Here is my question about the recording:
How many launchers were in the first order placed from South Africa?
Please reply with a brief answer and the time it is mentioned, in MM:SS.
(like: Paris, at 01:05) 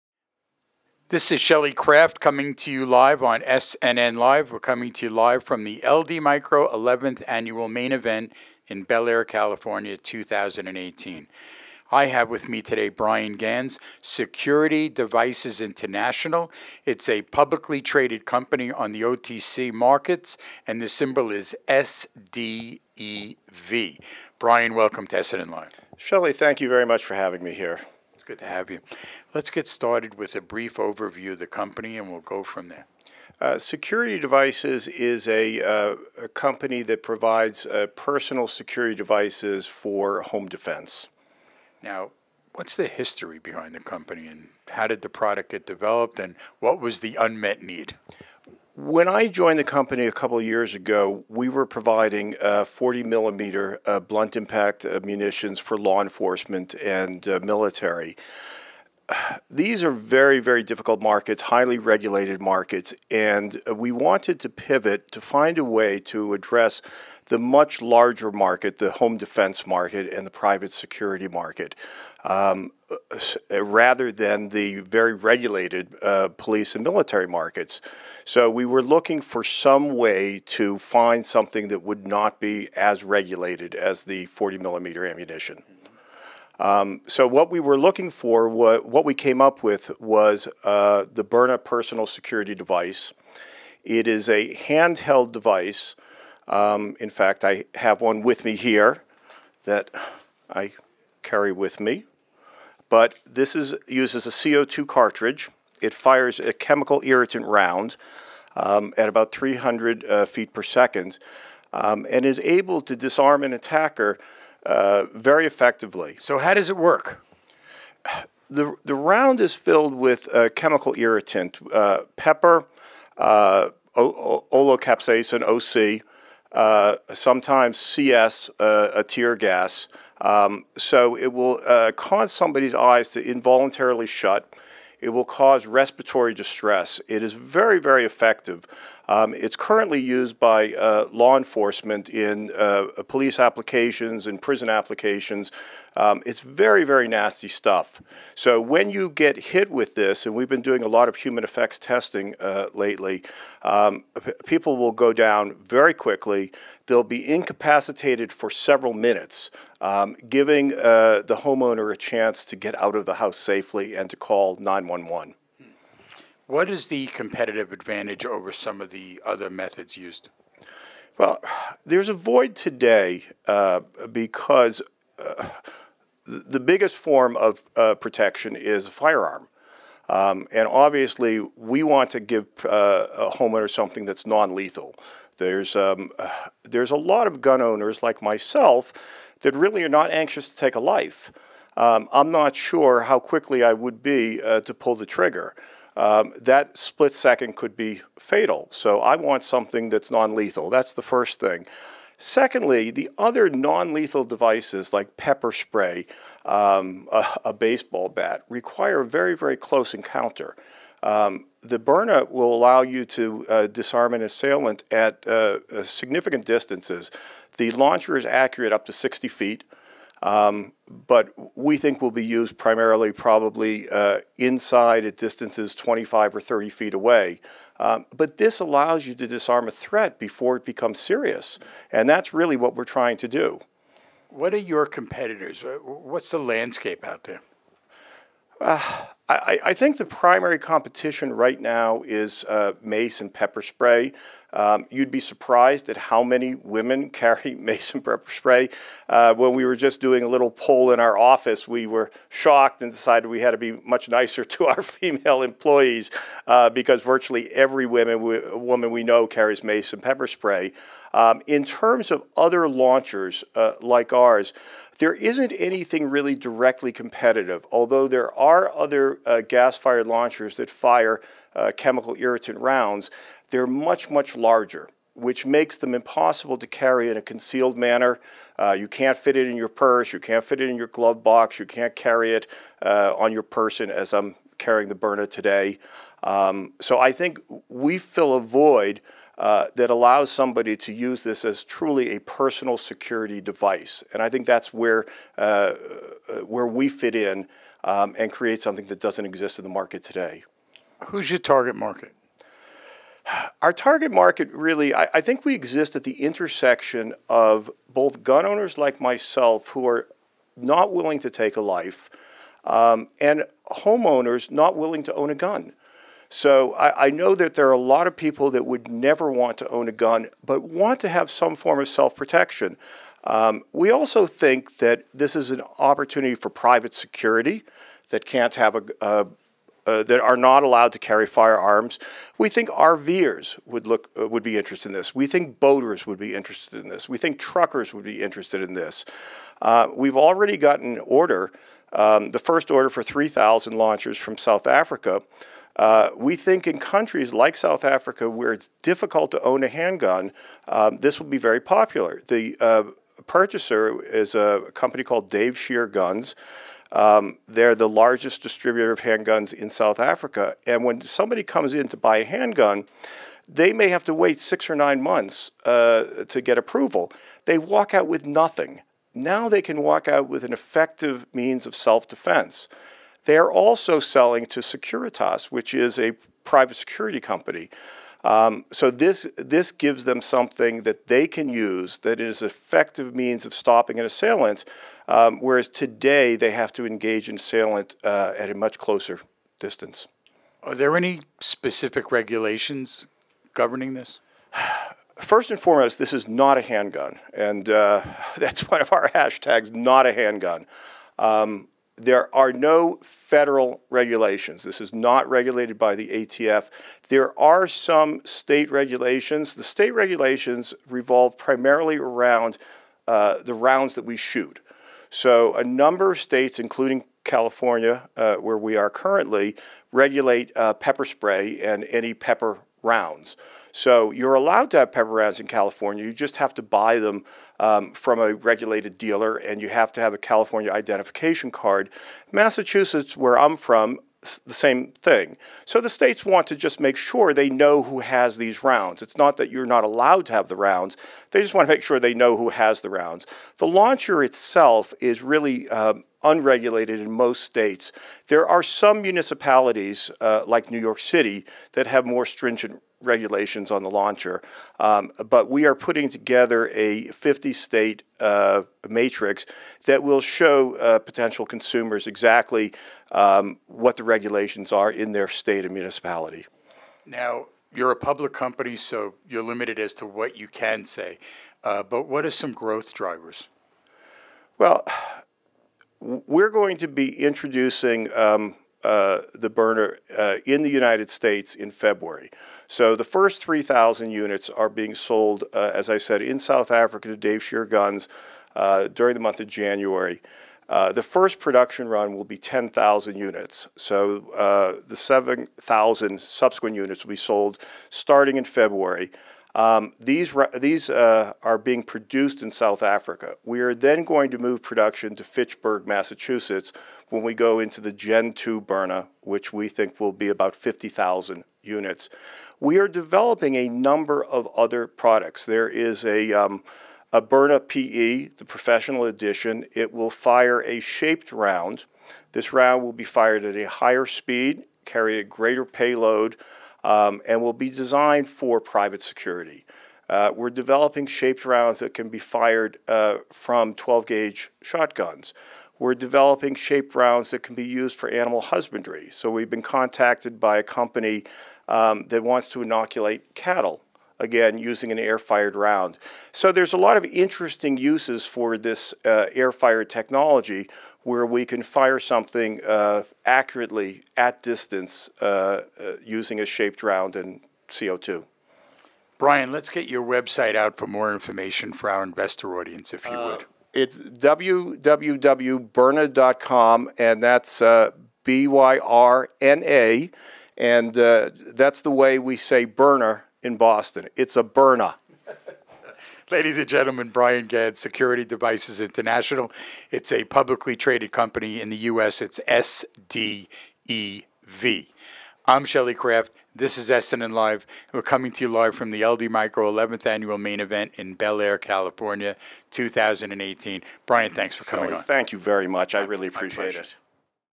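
3,000, at 05:43.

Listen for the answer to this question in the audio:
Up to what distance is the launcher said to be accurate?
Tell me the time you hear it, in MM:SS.
03:38.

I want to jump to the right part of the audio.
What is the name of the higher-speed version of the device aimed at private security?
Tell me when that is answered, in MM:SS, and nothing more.
08:37.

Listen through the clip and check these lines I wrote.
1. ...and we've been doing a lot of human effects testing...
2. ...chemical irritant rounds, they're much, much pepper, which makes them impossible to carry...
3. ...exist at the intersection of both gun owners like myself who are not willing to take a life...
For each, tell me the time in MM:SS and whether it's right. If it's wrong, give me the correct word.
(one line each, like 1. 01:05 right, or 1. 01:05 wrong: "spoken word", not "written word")
1. 02:30 right
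2. 04:31 wrong: "larger", not "pepper"
3. 05:05 right.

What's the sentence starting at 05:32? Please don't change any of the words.
We think RVers would look uh, would be interested in this.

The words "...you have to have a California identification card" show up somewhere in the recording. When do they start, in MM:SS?
07:09.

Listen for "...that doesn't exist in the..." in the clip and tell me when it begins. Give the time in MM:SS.
04:58.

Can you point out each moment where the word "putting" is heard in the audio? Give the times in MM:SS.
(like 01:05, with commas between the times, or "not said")
07:35.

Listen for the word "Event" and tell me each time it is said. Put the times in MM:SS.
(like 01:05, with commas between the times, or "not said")
00:07, 09:50.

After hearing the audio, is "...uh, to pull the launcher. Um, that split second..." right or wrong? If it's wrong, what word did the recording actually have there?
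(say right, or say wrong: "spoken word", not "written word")
wrong: "trigger", not "launcher".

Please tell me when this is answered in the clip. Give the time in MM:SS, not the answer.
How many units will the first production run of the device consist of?
08:12.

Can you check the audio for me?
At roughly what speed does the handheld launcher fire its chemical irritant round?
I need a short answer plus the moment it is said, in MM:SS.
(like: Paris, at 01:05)
300 feet per second, at 01:49.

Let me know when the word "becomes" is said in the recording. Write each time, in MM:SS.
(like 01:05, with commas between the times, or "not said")
03:50.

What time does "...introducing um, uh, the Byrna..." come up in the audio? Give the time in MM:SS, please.
07:57.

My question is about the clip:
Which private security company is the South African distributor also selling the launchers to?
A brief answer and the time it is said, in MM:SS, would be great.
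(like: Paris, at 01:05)
Securitas, at 06:14.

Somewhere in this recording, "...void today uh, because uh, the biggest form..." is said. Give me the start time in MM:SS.
02:52.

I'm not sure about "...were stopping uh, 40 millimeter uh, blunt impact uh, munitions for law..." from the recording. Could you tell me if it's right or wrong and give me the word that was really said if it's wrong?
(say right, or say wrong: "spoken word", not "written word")
wrong: "providing", not "stopping".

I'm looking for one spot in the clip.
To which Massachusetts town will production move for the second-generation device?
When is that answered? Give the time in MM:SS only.
08:25.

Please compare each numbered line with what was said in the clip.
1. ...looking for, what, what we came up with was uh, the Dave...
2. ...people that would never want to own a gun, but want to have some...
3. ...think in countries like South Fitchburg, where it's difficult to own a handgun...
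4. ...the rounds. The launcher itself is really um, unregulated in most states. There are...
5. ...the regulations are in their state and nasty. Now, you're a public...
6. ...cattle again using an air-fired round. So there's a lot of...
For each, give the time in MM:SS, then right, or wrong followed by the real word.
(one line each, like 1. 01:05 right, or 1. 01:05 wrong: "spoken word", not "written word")
1. 01:27 wrong: "Byrna", not "Dave"
2. 05:18 right
3. 05:46 wrong: "Africa", not "Fitchburg"
4. 07:22 right
5. 07:43 wrong: "municipality", not "nasty"
6. 09:03 right.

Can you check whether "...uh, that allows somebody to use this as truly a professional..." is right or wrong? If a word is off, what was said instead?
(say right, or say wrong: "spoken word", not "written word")
wrong: "personal", not "professional".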